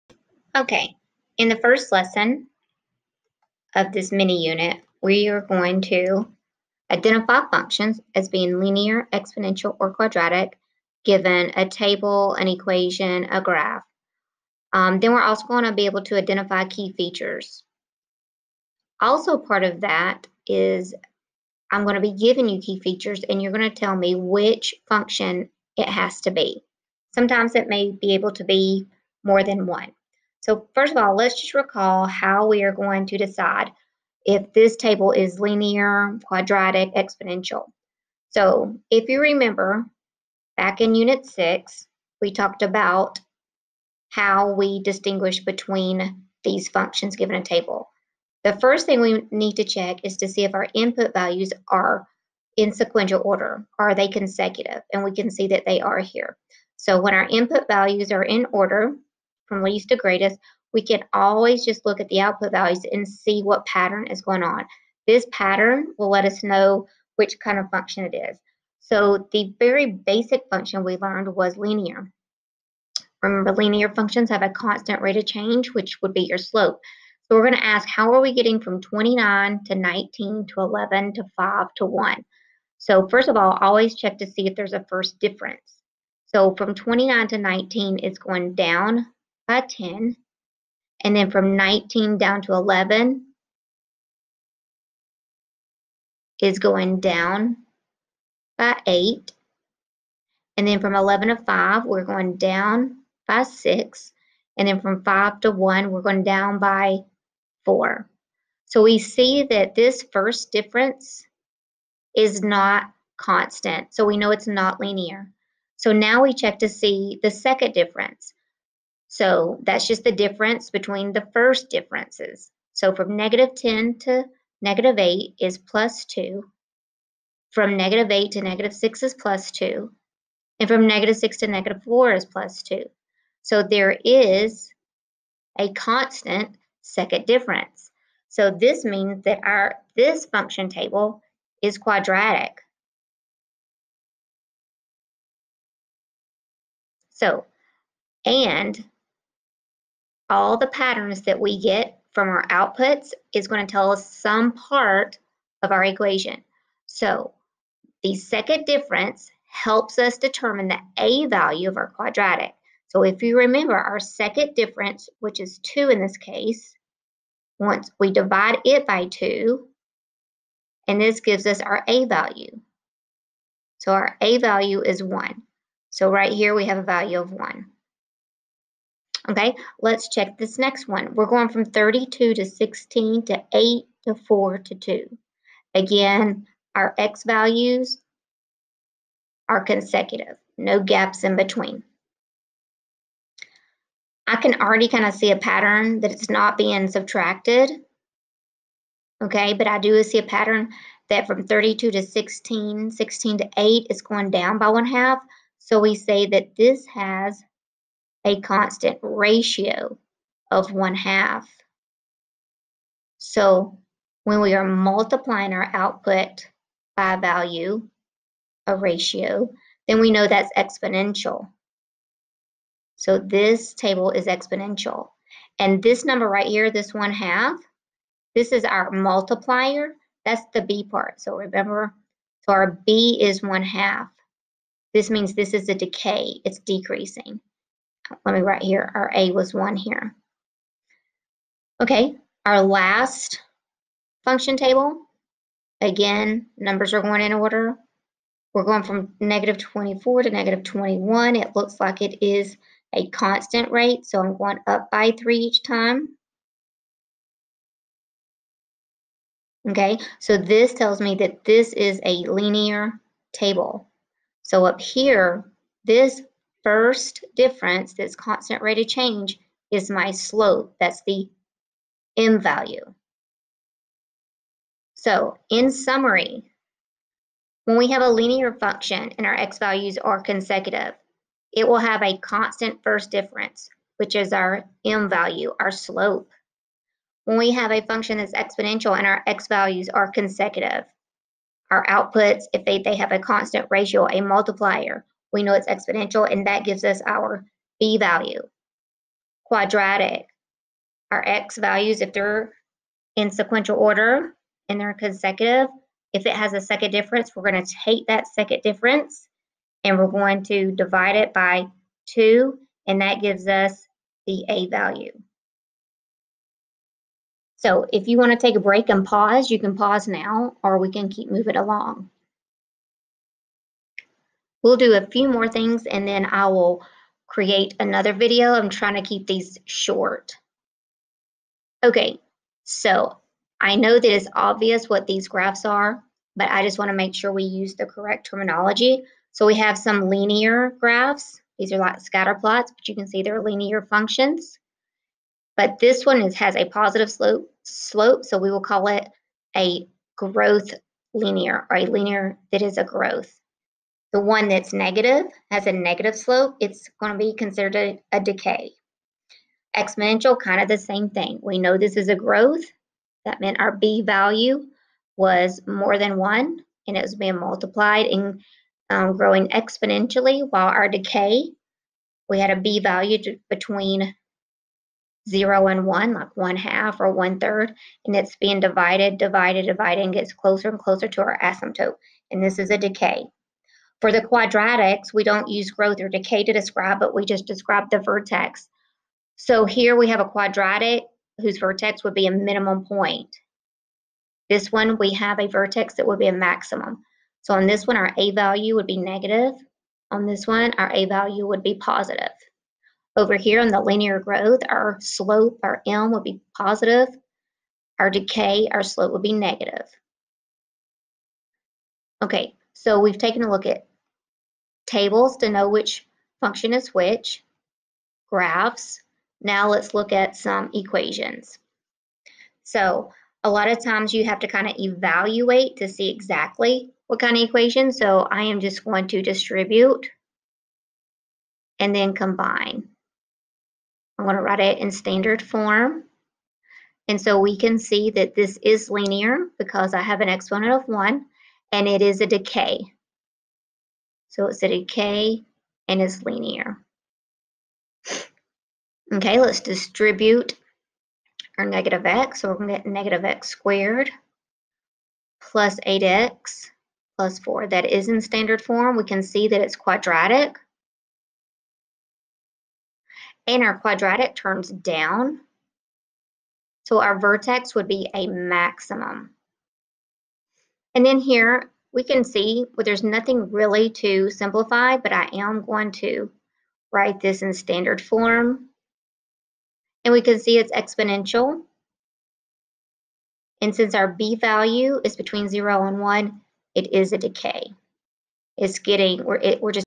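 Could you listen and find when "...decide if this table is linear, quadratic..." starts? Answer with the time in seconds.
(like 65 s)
33 s.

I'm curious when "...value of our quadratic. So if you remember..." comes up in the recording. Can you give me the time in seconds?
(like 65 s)
161 s.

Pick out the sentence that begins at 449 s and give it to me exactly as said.
Okay, let's distribute our negative x.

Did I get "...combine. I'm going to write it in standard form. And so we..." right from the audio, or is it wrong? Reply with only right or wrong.
right.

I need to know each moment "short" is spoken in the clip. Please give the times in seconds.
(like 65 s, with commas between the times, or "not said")
329 s.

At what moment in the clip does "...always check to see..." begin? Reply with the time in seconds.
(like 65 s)
83 s.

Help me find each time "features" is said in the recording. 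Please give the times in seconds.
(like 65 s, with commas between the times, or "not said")
16 s, 22 s.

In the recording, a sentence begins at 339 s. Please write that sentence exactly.
So we have some linear graphs.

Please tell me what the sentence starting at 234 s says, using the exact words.
This means this is a decay.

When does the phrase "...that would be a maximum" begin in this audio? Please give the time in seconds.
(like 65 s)
395 s.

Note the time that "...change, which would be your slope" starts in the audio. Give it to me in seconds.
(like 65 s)
75 s.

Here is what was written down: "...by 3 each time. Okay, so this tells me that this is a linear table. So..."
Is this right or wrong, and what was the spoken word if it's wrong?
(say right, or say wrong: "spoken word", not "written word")
right.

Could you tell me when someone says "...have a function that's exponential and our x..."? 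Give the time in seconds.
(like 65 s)
287 s.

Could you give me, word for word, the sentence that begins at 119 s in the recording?
So that's just the difference between the first differences.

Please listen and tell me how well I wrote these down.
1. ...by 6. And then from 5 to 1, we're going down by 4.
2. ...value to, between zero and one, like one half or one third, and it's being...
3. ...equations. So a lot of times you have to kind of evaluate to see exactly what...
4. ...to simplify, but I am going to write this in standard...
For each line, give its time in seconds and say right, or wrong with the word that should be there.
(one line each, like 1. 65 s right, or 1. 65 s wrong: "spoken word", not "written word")
1. 103 s right
2. 372 s right
3. 420 s right
4. 473 s right.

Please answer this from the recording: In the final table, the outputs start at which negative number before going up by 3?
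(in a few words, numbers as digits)
-24.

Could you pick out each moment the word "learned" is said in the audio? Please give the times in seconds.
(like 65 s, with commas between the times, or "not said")
70 s.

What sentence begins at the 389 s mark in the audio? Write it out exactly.
So here we have a quadratic whose vertex would be a minimum point.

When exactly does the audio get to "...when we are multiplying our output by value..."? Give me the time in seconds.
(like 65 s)
214 s.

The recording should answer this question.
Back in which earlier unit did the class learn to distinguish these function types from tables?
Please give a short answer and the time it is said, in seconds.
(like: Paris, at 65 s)
Unit 6, at 40 s.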